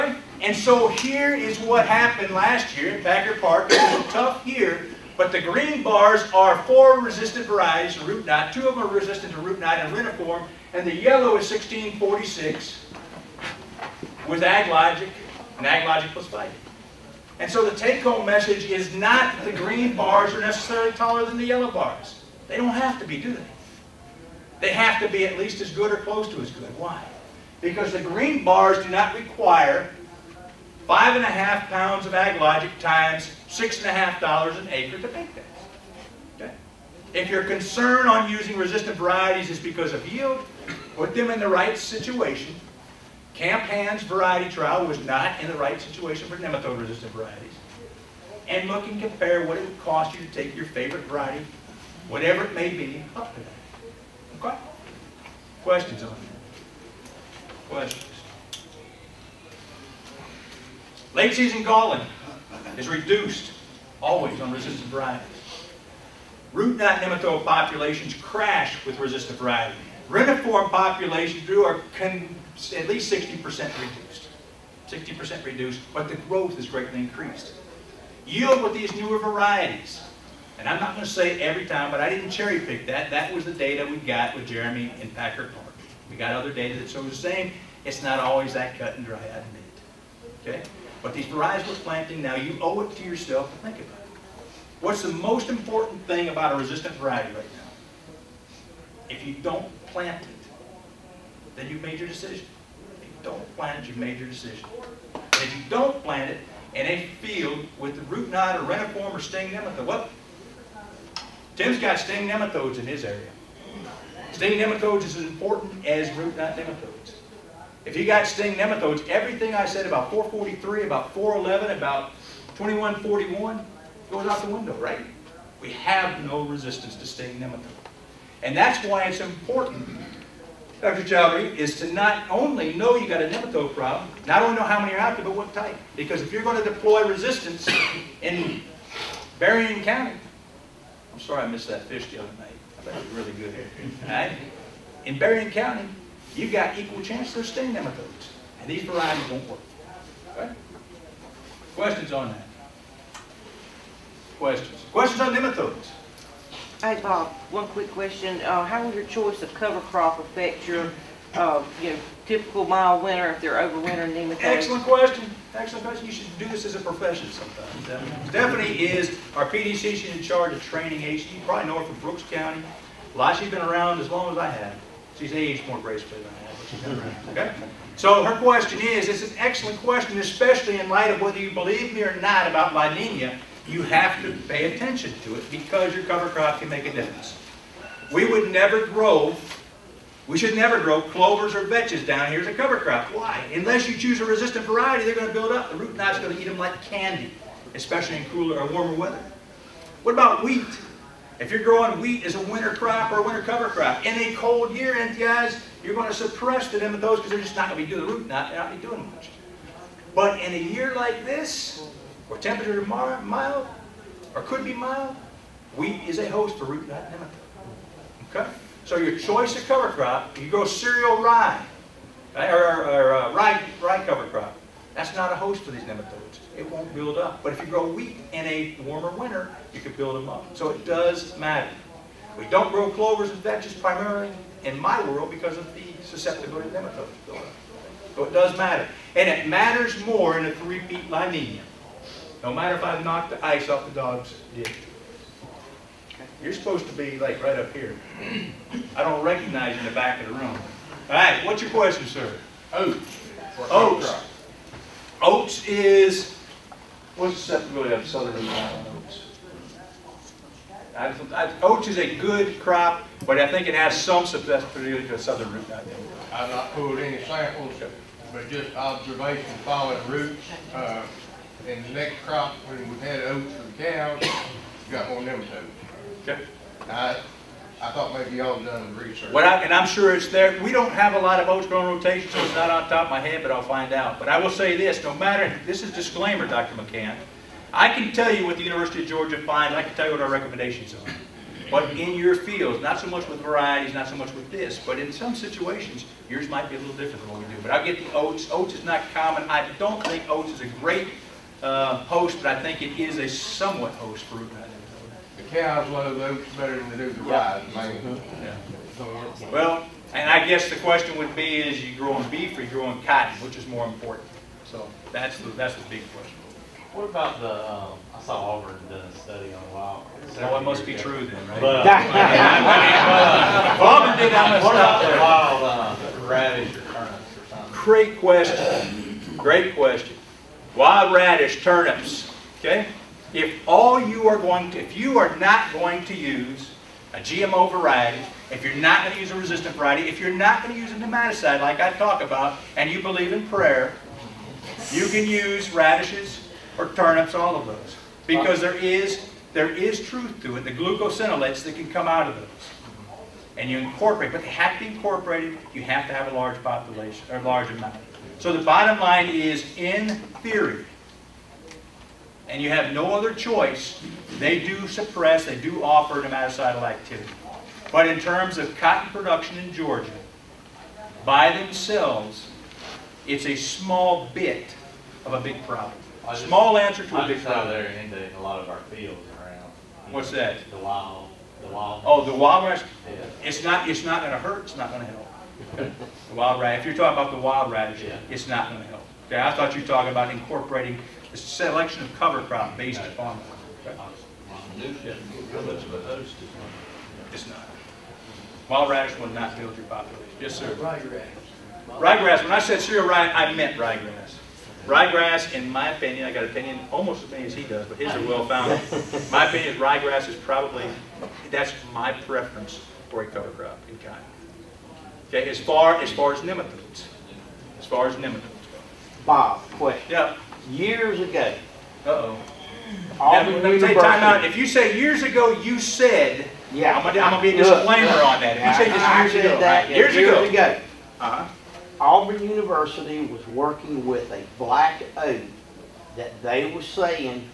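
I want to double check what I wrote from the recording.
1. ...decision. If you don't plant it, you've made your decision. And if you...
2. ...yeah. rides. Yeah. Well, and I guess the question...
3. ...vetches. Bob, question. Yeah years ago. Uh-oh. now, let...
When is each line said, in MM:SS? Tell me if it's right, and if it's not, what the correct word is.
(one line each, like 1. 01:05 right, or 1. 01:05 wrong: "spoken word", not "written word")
1. 01:42 right
2. 05:07 right
3. 06:58 wrong: "nematodes", not "vetches".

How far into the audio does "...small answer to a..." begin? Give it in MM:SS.
06:16.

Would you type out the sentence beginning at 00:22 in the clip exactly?
They don't have to be, do they?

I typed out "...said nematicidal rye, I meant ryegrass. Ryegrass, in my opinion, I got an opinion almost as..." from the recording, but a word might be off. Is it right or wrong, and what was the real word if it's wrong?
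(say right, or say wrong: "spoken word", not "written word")
wrong: "cereal", not "nematicidal".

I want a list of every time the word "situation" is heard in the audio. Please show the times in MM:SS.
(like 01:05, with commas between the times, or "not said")
00:41, 00:45, 04:55.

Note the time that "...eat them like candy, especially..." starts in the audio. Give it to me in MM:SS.
03:16.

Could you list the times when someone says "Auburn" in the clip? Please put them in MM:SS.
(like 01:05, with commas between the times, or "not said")
05:18, 05:23, 07:11.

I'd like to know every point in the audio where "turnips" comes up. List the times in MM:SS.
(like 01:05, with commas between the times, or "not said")
05:26, 05:31, 05:46.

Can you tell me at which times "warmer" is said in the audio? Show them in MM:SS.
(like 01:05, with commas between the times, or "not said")
03:18, 03:48.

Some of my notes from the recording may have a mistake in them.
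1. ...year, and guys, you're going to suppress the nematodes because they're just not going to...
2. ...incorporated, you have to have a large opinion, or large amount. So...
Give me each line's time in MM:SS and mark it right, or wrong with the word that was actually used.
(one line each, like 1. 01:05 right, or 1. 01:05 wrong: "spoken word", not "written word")
1. 03:24 right
2. 05:54 wrong: "population", not "opinion".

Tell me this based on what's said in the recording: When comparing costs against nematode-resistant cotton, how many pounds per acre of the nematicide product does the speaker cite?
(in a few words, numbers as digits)
5.5 pounds.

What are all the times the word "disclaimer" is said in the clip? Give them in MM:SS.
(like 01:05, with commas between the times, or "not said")
04:45, 07:07.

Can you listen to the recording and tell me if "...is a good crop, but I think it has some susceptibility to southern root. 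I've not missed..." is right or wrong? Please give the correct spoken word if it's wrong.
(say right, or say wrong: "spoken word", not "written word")
wrong: "pulled", not "missed".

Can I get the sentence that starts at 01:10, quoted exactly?
Reniform populations are at least 60% reduced.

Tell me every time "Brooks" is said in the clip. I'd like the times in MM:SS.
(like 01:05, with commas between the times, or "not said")
02:51.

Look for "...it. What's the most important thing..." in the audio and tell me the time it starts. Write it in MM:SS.
01:34.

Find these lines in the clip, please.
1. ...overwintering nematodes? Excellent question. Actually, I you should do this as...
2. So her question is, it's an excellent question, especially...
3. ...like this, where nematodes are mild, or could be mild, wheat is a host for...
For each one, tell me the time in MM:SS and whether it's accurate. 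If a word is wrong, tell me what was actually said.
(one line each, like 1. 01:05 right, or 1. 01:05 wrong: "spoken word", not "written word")
1. 02:43 right
2. 02:57 right
3. 03:30 wrong: "temperatures", not "nematodes".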